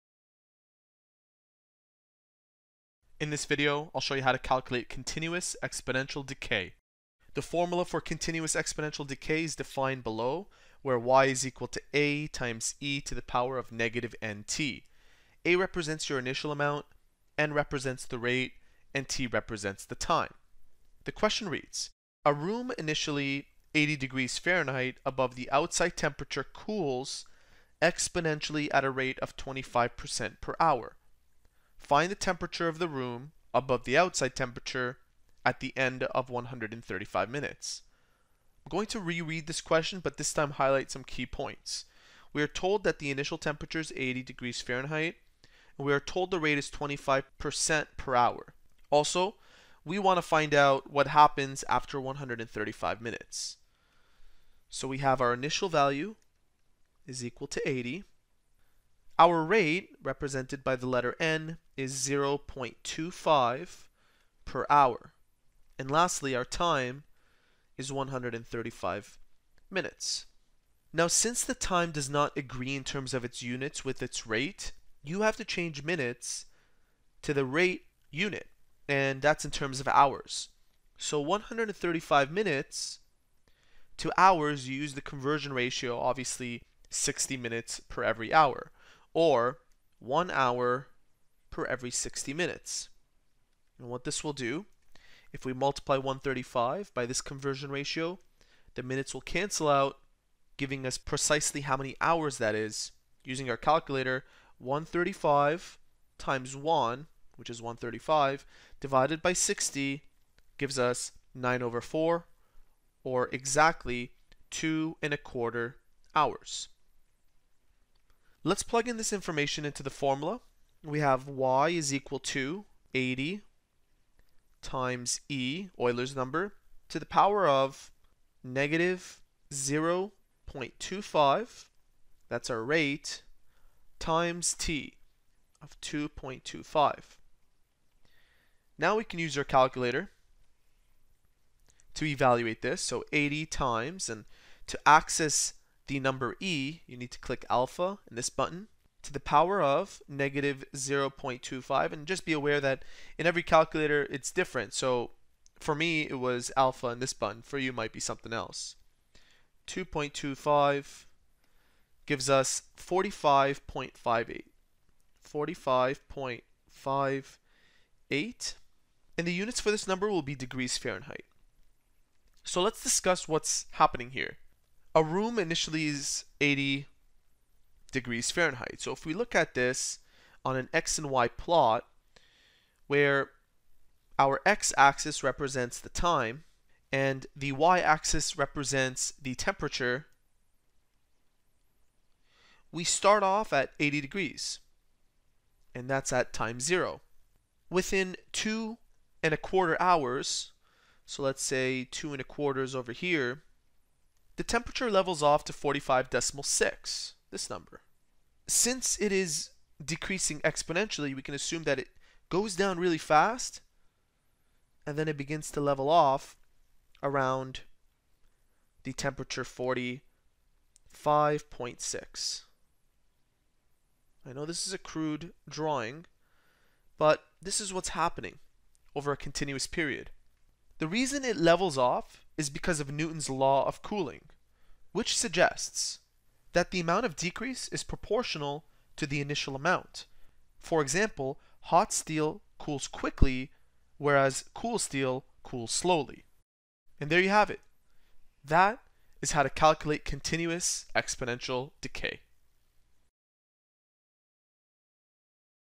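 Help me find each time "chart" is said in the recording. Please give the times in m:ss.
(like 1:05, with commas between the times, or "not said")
not said.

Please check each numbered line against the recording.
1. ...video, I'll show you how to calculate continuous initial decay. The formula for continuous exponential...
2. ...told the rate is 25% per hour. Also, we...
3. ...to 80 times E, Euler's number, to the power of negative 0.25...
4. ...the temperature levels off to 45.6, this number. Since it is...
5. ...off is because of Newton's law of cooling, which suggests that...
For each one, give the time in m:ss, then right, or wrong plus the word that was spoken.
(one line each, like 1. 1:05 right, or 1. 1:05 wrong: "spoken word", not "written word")
1. 0:03 wrong: "exponential", not "initial"
2. 0:45 right
3. 2:02 right
4. 3:24 right
5. 3:51 right.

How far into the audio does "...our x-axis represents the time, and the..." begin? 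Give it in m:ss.
3:04.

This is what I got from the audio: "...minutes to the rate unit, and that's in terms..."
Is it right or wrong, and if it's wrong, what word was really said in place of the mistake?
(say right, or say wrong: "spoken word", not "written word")
right.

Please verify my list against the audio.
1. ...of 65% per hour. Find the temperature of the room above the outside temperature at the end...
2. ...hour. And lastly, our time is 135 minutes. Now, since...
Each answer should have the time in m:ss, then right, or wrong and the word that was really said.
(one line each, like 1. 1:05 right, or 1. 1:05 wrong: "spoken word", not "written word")
1. 0:29 wrong: "25", not "65"
2. 1:04 right.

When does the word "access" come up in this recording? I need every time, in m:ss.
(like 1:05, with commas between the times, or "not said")
2:24.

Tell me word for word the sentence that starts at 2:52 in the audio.
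So let's discuss what's happening here a room initially is 80 degrees Fahrenheit.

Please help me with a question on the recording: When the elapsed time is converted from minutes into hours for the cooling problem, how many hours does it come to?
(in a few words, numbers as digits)
2 and a quarter hours.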